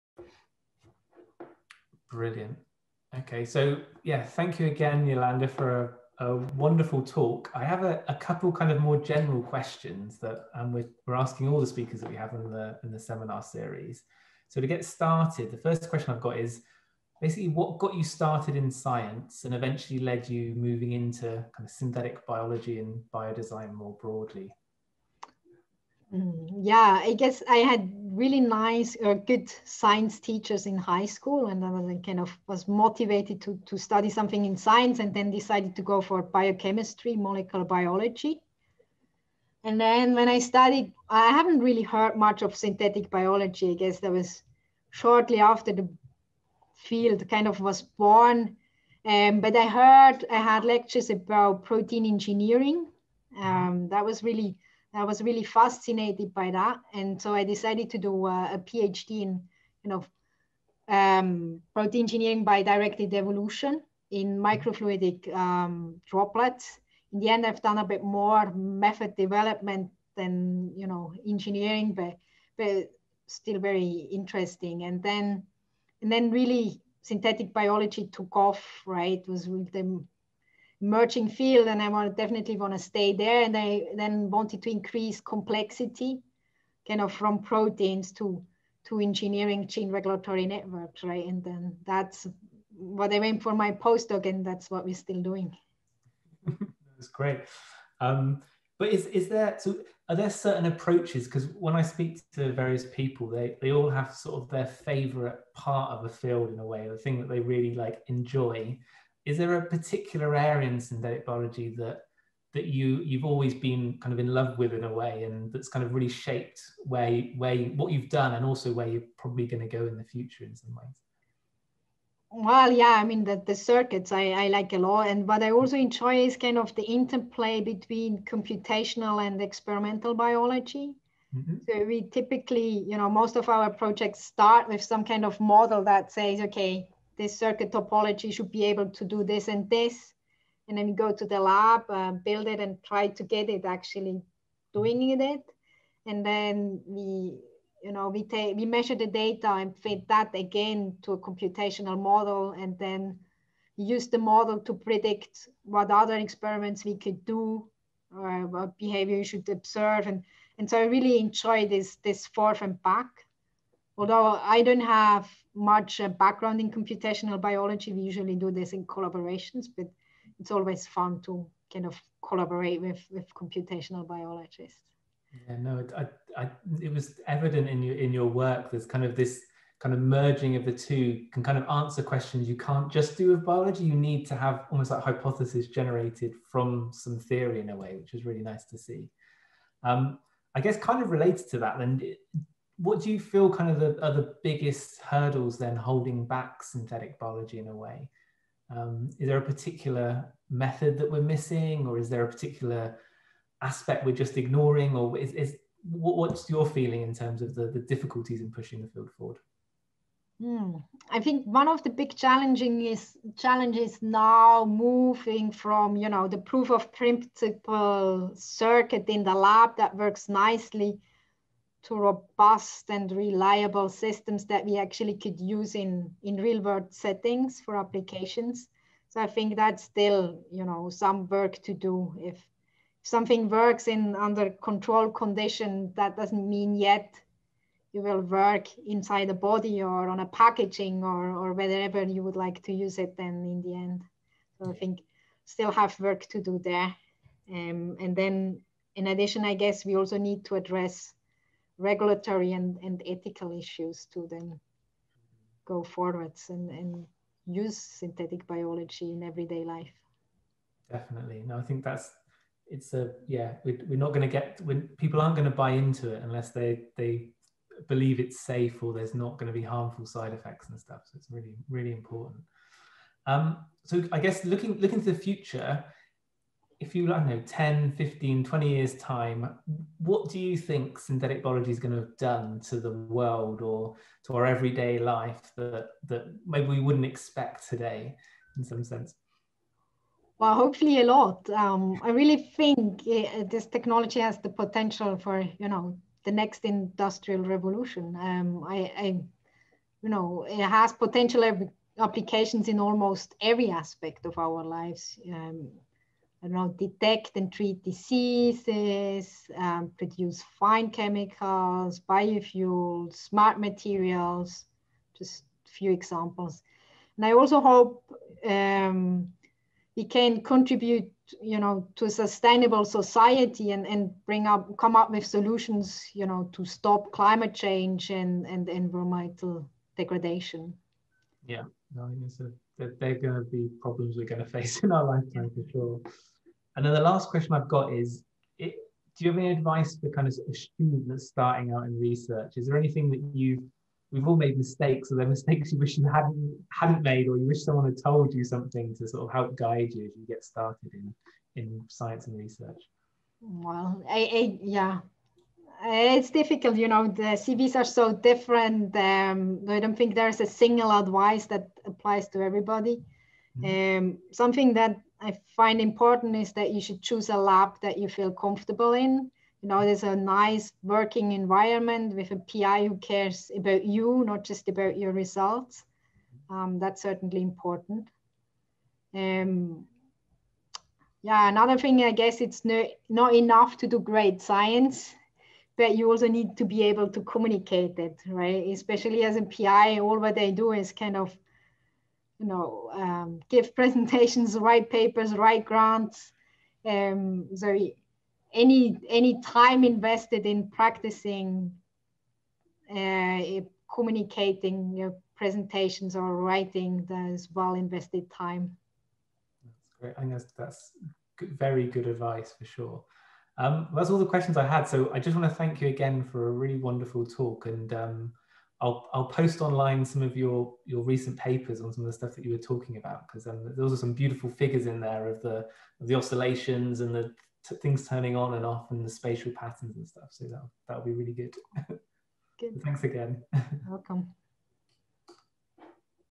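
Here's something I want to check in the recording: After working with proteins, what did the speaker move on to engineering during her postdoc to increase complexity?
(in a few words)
Gene regulatory networks.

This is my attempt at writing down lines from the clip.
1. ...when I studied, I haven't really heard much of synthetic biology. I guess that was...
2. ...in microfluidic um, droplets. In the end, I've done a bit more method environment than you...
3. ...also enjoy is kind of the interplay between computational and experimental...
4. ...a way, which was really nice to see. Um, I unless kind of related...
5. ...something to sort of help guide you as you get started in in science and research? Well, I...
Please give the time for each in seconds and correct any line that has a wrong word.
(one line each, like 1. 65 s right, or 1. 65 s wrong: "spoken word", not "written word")
1. 40 s right
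2. 64 s wrong: "development", not "environment"
3. 125 s right
4. 187 s wrong: "guess", not "unless"
5. 348 s right.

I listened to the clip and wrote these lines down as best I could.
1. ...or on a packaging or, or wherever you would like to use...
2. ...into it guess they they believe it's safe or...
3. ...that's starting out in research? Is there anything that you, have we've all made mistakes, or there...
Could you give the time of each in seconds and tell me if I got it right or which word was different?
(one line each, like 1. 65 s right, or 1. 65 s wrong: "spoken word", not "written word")
1. 239 s right
2. 265 s wrong: "unless", not "guess"
3. 341 s right.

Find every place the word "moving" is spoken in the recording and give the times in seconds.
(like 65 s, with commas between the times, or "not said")
20 s, 214 s.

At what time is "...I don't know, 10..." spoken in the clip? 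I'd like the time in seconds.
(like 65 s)
277 s.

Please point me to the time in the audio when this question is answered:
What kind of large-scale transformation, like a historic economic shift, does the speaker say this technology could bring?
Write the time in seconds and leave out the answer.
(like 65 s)
296 s.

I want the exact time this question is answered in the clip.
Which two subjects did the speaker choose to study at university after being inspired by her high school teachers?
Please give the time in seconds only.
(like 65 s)
36 s.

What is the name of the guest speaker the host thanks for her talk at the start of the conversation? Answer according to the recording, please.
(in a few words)
Yolanda.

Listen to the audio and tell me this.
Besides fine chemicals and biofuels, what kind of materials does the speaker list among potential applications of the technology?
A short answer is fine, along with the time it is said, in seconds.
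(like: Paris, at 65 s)
Smart materials, at 313 s.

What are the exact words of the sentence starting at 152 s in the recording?
And then use the model to predict what other experiments we could do or uh, what behavior you should observe.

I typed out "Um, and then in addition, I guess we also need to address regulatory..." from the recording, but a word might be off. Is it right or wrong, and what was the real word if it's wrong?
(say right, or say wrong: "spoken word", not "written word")
right.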